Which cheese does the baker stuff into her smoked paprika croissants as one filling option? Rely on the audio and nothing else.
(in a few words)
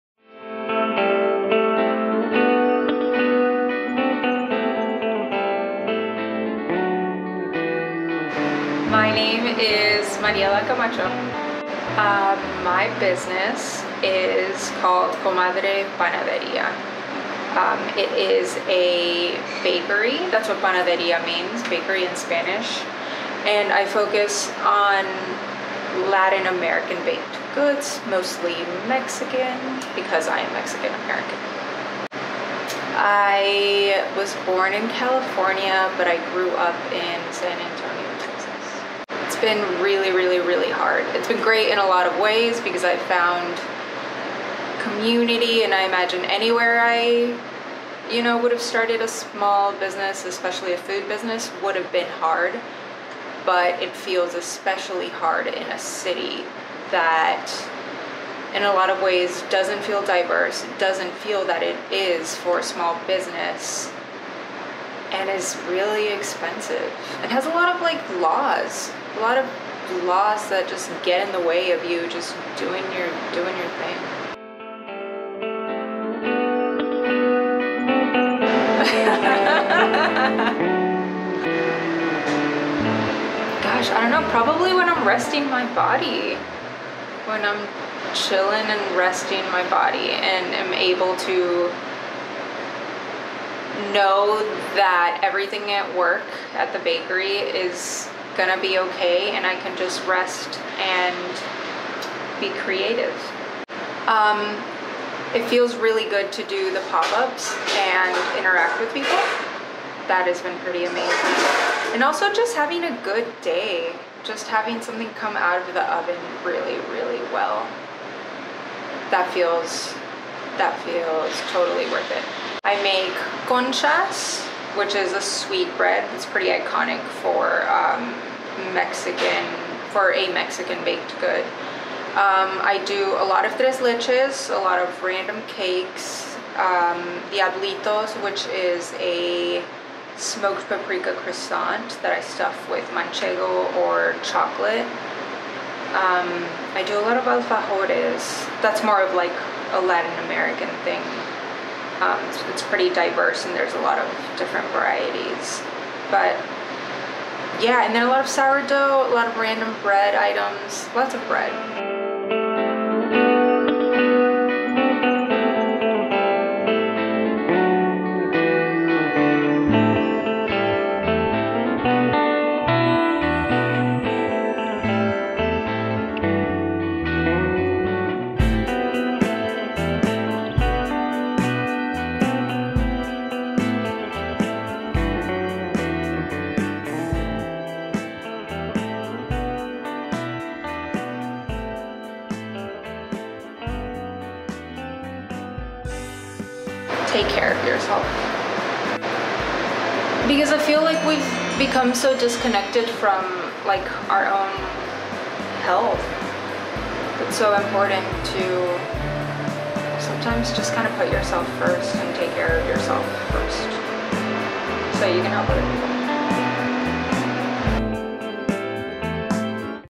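manchego.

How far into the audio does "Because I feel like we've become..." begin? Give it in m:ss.
3:20.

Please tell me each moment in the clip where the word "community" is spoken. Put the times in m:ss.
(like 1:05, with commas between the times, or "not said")
0:44.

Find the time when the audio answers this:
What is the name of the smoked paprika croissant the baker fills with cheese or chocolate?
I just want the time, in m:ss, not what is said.
2:17.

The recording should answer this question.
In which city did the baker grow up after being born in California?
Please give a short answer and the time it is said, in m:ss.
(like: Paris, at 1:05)
San Antonio, at 0:37.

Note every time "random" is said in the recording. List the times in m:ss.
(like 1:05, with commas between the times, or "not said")
2:15, 2:39.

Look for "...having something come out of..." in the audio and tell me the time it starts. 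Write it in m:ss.
1:54.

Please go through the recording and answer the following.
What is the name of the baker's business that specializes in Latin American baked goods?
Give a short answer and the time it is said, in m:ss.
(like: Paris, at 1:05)
Comadre Panaderia, at 0:15.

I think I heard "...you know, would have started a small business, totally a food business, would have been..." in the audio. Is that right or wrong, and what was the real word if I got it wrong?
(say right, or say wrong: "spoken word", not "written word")
wrong: "especially", not "totally".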